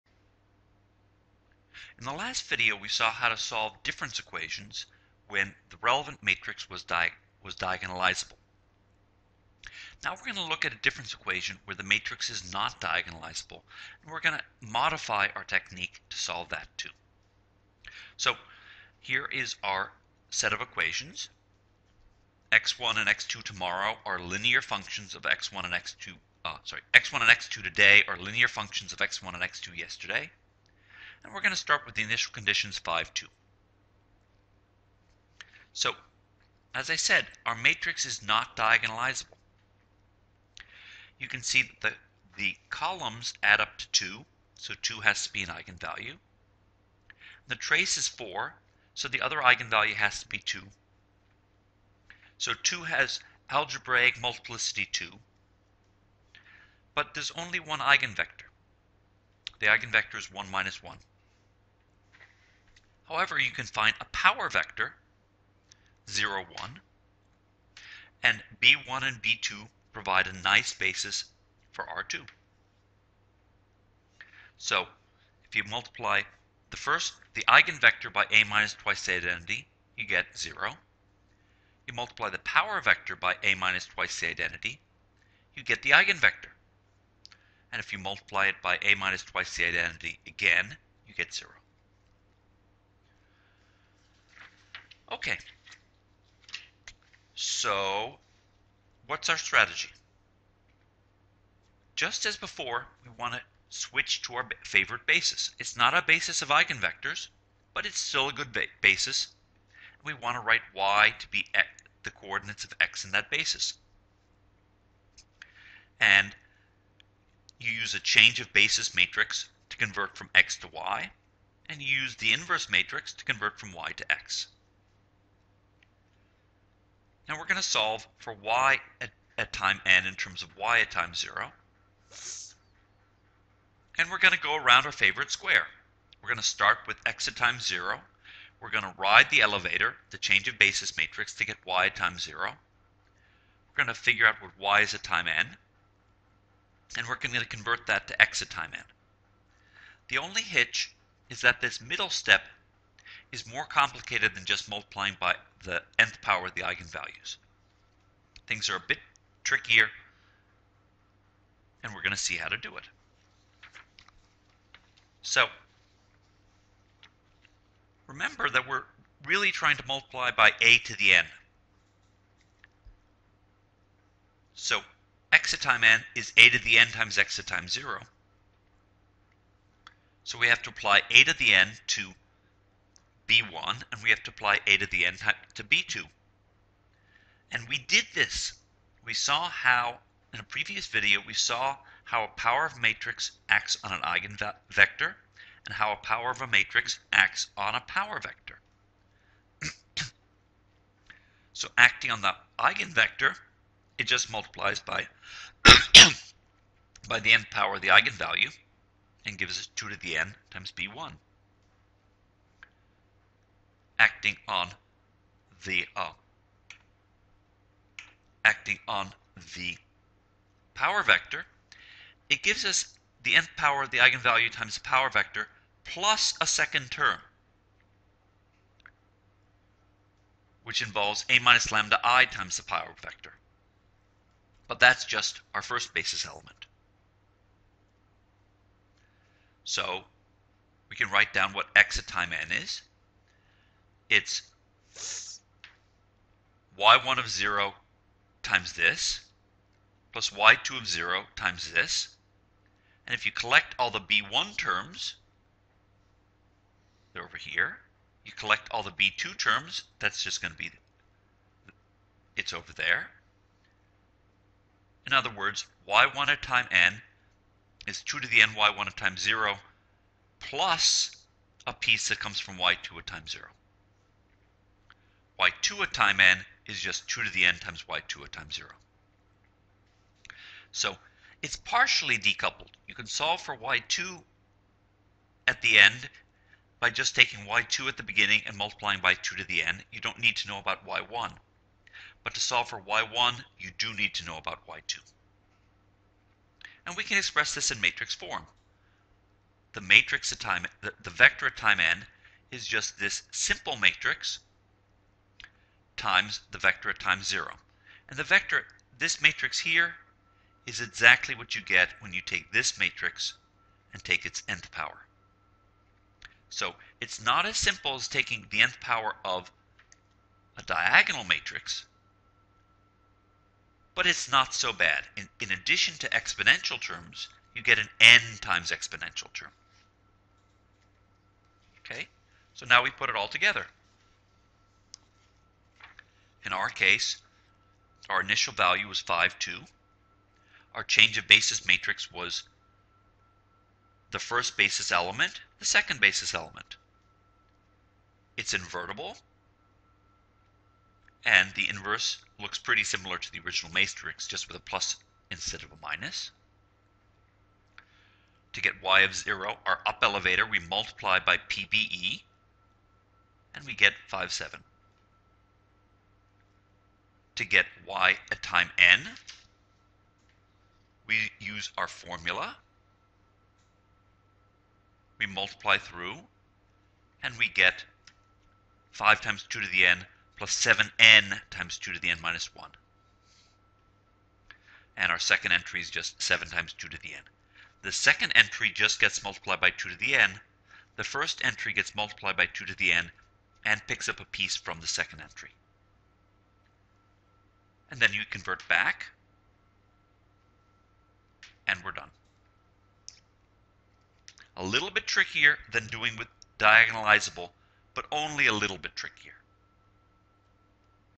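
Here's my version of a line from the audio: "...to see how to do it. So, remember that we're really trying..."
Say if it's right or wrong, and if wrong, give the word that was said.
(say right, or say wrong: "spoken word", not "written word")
right.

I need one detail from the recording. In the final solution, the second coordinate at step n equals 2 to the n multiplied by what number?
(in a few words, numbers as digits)
7.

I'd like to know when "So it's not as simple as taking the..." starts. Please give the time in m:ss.
5:16.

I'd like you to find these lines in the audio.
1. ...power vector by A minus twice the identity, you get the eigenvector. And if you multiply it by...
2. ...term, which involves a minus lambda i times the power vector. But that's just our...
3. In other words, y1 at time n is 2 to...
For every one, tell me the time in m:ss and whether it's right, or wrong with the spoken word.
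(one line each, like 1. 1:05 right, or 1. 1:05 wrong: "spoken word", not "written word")
1. 1:22 right
2. 3:46 right
3. 4:25 right.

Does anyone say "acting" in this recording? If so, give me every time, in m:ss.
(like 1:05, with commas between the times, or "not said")
3:21, 3:34, 3:38.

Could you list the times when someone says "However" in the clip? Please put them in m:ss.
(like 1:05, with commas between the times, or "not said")
1:03.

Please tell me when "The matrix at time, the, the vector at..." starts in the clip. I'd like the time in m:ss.
4:59.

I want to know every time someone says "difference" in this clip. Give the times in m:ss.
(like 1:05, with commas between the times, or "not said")
0:03, 0:10.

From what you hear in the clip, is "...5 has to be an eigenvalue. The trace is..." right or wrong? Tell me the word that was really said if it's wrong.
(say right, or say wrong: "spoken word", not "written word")
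wrong: "2", not "5".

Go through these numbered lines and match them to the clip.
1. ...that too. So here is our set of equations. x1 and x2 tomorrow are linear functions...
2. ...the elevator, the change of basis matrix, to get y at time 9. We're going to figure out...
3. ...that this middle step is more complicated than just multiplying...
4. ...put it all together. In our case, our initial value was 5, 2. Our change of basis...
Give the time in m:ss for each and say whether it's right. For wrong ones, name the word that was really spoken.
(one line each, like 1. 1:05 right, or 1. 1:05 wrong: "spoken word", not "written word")
1. 0:16 right
2. 2:19 wrong: "0", not "9"
3. 2:31 right
4. 5:32 right.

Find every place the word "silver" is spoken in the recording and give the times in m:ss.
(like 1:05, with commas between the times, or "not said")
not said.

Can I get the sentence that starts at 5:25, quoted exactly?
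In, in addition to exponential terms, you get an n times exponential term.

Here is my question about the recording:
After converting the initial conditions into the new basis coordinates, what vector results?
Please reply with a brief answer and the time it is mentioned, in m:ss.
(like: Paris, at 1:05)
5, 7, at 6:04.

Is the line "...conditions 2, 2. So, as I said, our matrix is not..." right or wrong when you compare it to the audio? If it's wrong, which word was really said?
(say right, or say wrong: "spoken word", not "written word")
wrong: "5", not "2".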